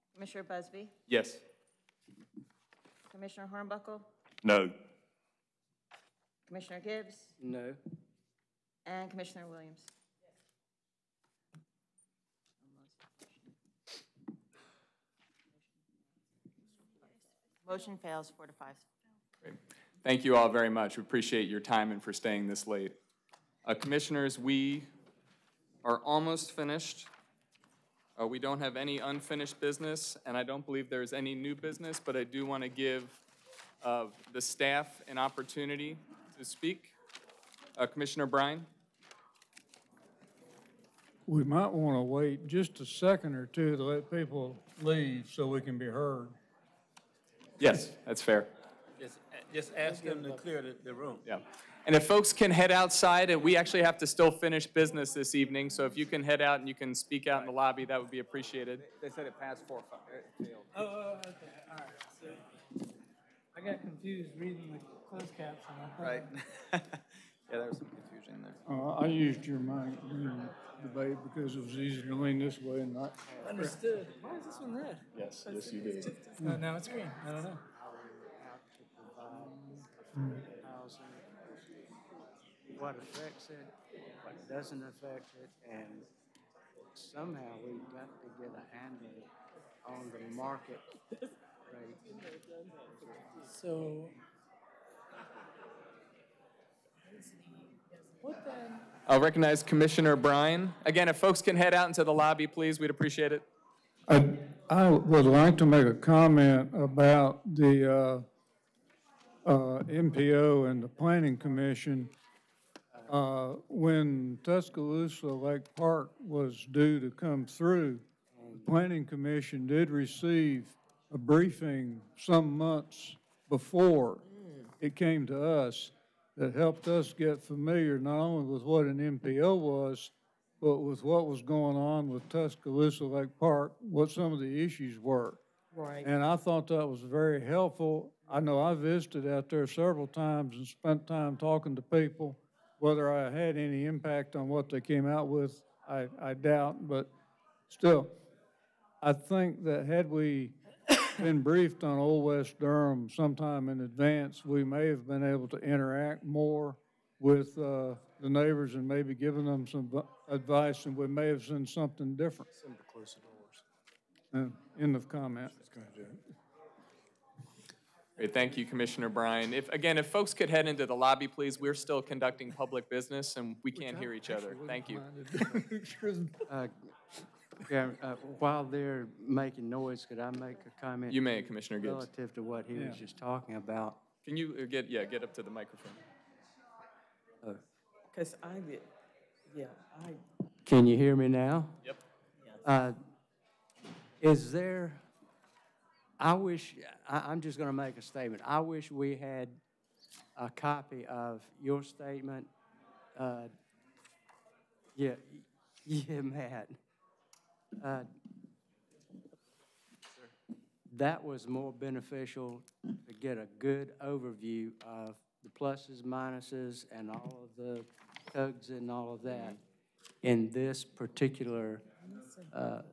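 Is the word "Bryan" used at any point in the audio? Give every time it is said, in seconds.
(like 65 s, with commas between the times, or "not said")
38 s, 100 s, 169 s.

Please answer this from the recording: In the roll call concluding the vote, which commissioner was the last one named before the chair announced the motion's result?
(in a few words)
Williams.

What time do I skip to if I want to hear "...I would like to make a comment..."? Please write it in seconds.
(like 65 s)
104 s.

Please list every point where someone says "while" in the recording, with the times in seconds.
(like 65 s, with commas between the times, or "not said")
178 s.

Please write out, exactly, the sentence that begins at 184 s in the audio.
Can you uh, get, yeah, get up to the microphone.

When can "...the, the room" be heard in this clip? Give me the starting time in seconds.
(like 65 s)
50 s.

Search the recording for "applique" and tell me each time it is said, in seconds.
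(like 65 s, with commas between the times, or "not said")
not said.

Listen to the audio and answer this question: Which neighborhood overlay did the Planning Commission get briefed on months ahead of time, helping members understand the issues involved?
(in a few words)
Tuscaloosa-Lakewood.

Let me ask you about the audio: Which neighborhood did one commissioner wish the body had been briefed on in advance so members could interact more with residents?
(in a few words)
Old West Durham.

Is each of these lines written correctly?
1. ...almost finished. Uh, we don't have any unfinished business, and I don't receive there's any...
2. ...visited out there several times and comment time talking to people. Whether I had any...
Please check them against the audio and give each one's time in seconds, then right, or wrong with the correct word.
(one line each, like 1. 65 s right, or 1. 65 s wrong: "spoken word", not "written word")
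1. 26 s wrong: "believe", not "receive"
2. 138 s wrong: "spent", not "comment".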